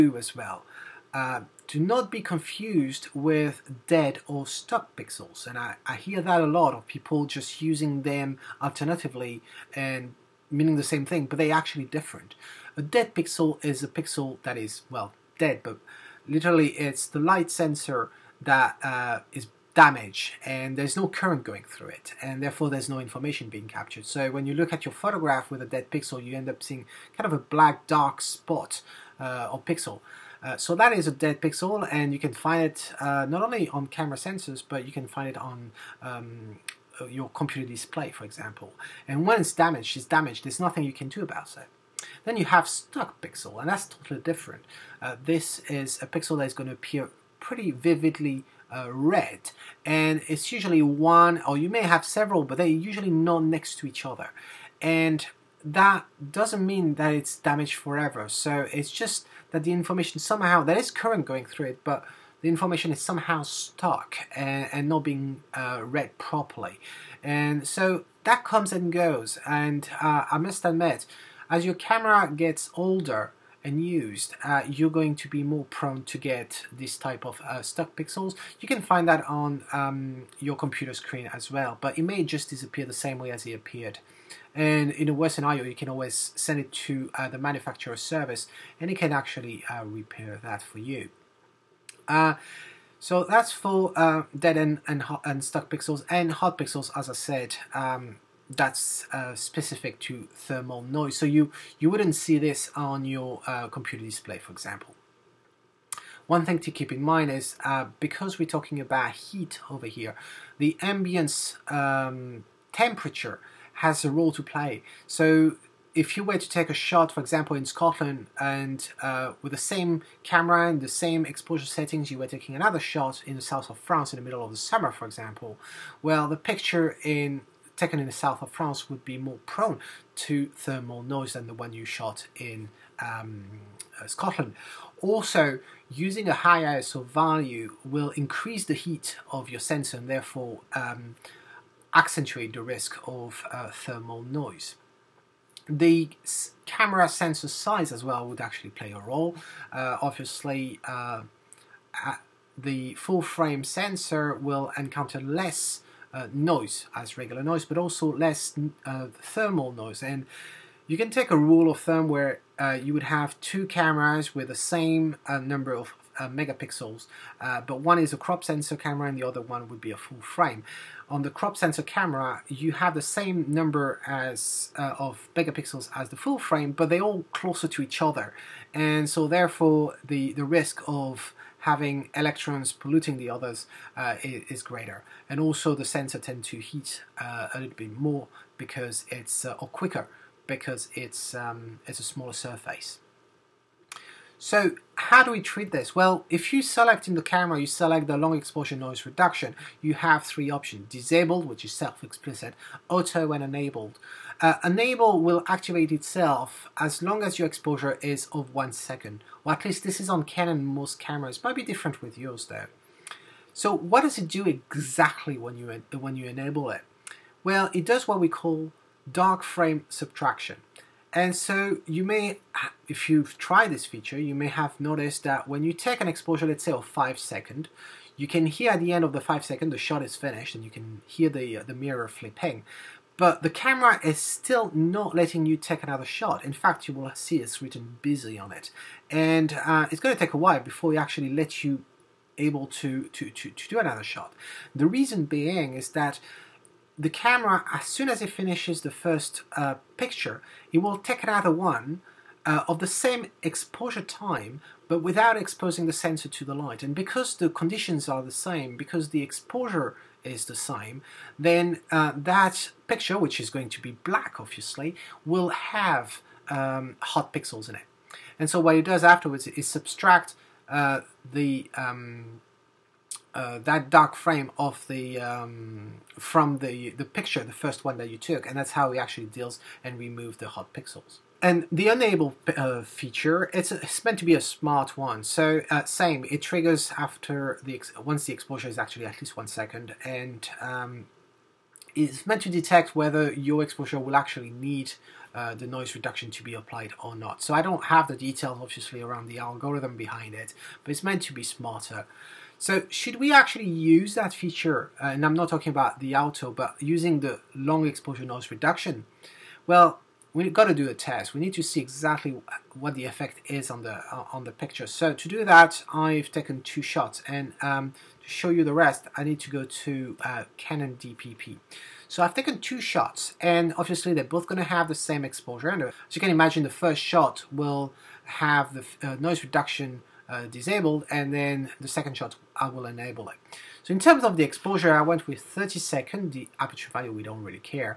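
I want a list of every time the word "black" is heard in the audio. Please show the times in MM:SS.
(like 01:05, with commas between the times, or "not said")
00:27, 04:24.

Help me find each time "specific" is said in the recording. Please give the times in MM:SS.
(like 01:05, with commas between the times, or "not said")
01:39.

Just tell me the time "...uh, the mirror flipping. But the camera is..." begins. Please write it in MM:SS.
03:51.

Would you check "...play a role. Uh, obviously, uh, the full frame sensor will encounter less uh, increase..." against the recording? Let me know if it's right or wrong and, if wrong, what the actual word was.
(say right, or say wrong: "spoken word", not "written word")
wrong: "noise", not "increase".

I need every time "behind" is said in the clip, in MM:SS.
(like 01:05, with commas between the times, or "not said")
04:59.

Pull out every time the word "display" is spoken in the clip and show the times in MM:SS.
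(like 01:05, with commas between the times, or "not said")
00:37, 01:44.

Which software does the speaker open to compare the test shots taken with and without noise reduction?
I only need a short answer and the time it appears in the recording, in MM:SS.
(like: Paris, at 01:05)
Canon DPP, at 05:20.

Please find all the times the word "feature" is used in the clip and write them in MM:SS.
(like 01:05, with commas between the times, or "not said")
03:43, 04:42, 05:04.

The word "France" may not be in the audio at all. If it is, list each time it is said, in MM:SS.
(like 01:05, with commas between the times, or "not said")
02:03, 02:08.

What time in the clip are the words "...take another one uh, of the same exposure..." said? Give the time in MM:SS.
04:10.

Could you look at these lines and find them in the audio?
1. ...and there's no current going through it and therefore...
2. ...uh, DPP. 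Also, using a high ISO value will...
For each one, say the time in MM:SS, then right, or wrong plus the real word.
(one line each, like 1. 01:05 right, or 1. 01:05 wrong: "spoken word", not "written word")
1. 00:20 right
2. 02:14 wrong: "Scotland", not "DPP".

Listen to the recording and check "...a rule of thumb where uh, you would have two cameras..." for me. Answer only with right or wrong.
right.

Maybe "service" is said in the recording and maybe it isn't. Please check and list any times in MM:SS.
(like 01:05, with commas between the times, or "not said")
01:28.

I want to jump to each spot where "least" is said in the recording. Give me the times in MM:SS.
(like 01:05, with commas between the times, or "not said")
03:29, 04:49.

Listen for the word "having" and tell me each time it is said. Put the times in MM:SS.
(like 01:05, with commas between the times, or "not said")
03:01.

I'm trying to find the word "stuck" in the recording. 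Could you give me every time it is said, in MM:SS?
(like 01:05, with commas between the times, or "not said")
00:04, 00:42, 01:03, 01:17, 01:35.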